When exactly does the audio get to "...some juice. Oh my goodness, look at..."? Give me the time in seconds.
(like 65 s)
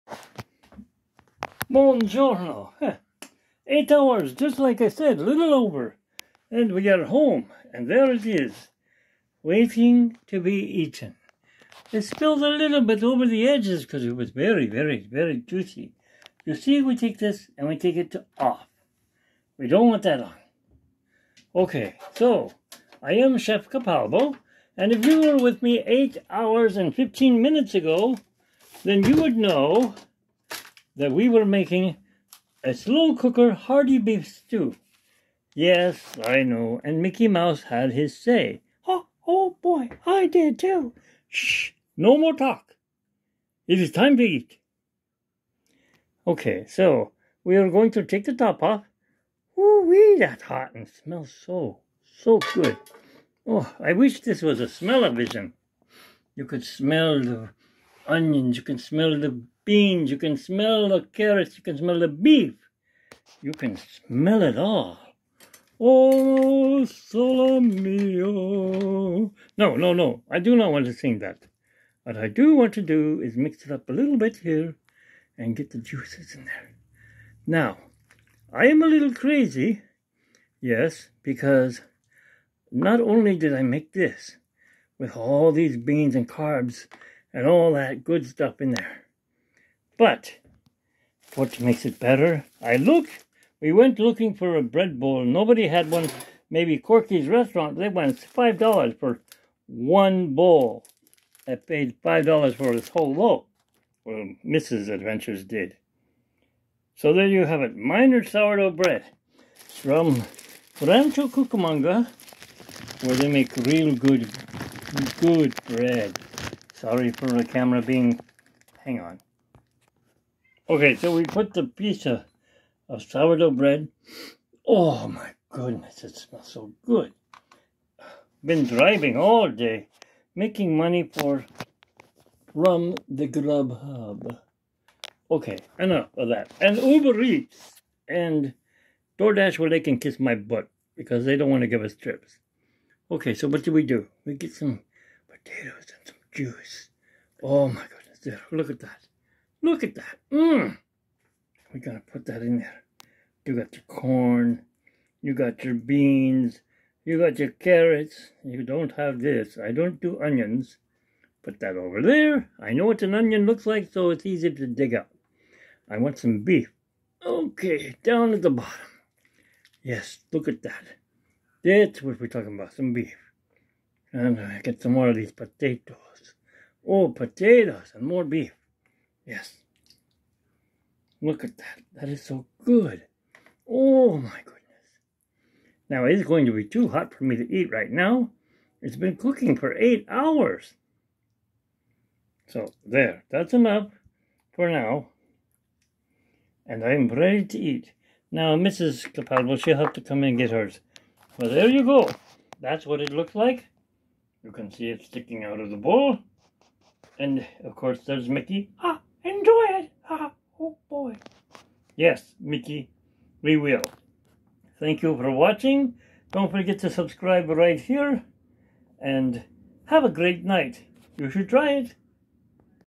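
146 s.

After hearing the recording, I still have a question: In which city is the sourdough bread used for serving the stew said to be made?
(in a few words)
Rancho Cucamonga.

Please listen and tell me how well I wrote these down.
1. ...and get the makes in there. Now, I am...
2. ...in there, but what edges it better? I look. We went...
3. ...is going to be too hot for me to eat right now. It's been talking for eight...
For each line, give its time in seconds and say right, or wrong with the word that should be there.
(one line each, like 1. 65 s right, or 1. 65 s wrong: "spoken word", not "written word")
1. 75 s wrong: "juices", not "makes"
2. 88 s wrong: "makes", not "edges"
3. 186 s wrong: "cooking", not "talking".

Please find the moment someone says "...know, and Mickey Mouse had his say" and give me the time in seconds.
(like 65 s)
36 s.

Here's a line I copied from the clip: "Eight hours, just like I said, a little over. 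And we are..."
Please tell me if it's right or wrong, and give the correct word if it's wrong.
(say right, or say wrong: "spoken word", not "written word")
right.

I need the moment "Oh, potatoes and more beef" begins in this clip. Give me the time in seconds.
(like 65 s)
176 s.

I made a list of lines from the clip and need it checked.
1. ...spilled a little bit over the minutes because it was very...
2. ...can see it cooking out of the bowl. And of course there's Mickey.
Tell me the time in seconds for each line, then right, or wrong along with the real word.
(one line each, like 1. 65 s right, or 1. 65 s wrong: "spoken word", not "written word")
1. 12 s wrong: "edges", not "minutes"
2. 204 s wrong: "sticking", not "cooking".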